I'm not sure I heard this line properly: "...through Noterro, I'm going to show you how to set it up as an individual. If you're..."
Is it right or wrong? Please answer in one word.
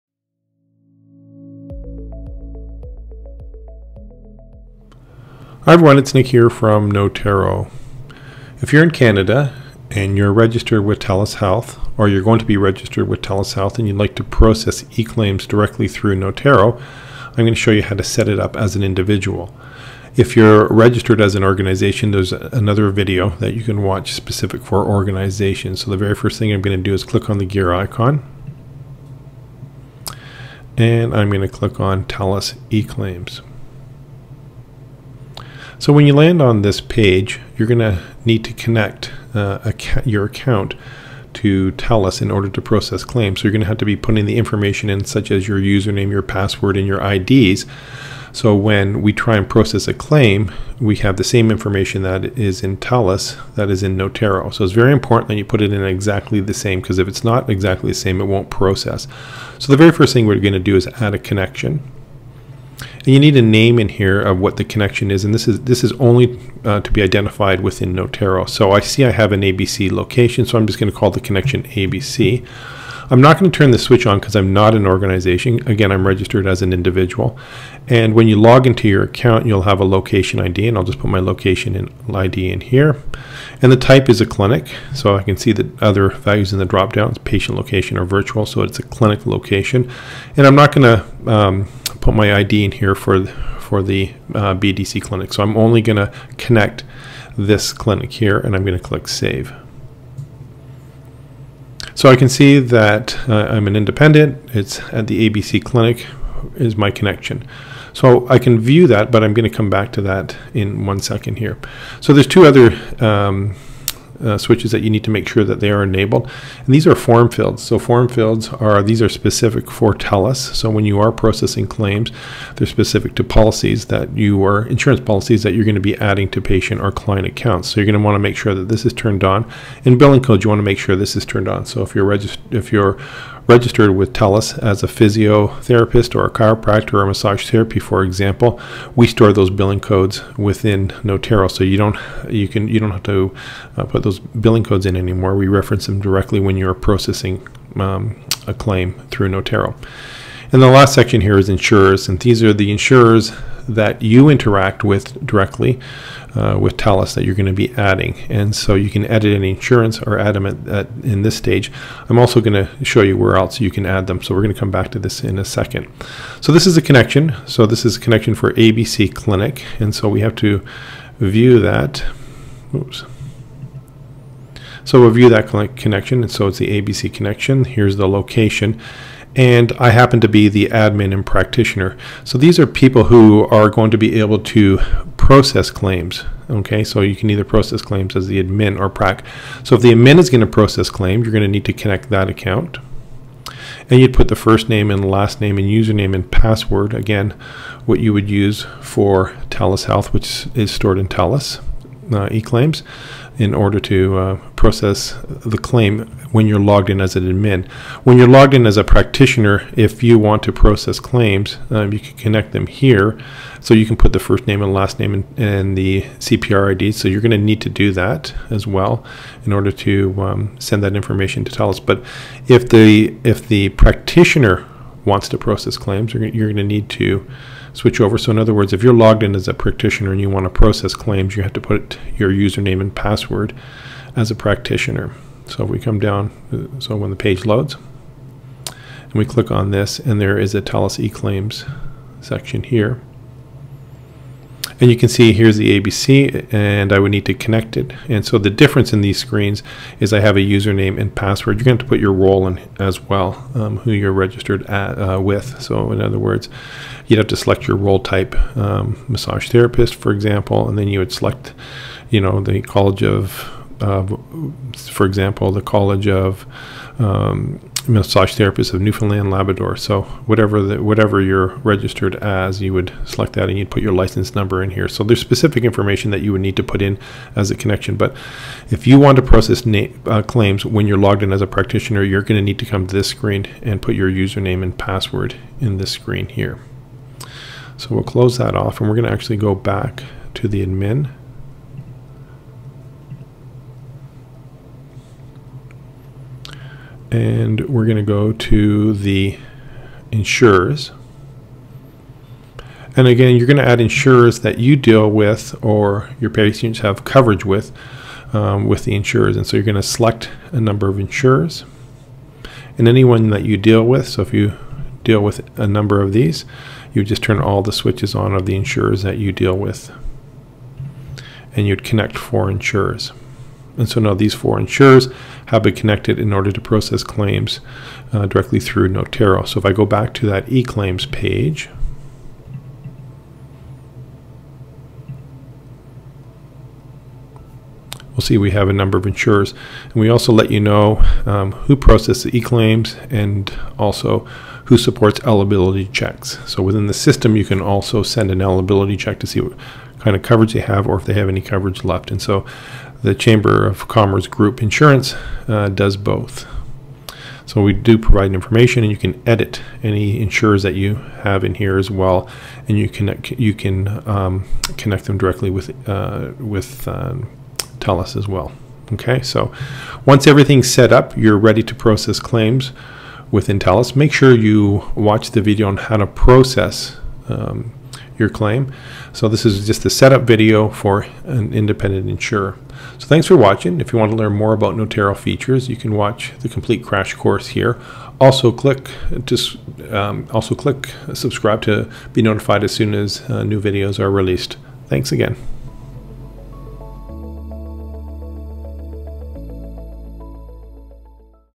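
right.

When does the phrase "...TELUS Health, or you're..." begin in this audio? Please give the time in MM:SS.
00:10.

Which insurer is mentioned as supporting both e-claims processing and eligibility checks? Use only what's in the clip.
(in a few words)
Chamber of Commerce Group Insurance.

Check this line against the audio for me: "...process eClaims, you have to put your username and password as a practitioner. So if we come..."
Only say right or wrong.
wrong.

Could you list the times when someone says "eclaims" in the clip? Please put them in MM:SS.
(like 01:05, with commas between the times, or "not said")
03:22, 04:01.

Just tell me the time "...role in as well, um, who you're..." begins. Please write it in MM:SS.
04:12.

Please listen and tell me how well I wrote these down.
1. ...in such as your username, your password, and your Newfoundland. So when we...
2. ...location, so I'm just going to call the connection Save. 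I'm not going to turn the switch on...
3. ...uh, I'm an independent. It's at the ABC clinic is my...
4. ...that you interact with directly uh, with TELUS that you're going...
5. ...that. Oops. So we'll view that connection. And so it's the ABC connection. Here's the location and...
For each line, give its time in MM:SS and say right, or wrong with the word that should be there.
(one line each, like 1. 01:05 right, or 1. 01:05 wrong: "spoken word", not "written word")
1. 00:44 wrong: "IDs", not "Newfoundland"
2. 01:09 wrong: "ABC", not "Save"
3. 01:43 right
4. 02:33 right
5. 02:51 right.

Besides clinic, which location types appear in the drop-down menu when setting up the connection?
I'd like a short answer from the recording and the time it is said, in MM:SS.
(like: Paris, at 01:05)
Patient location or virtual, at 01:27.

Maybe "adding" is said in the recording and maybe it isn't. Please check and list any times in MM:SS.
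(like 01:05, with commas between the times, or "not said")
02:05, 02:37.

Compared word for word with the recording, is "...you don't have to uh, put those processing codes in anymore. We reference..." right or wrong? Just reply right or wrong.
wrong.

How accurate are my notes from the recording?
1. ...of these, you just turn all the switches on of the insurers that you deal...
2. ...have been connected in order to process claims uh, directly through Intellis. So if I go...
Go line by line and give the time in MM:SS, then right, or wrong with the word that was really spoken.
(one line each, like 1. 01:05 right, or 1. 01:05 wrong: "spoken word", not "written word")
1. 05:16 right
2. 05:25 wrong: "Noterro", not "Intellis".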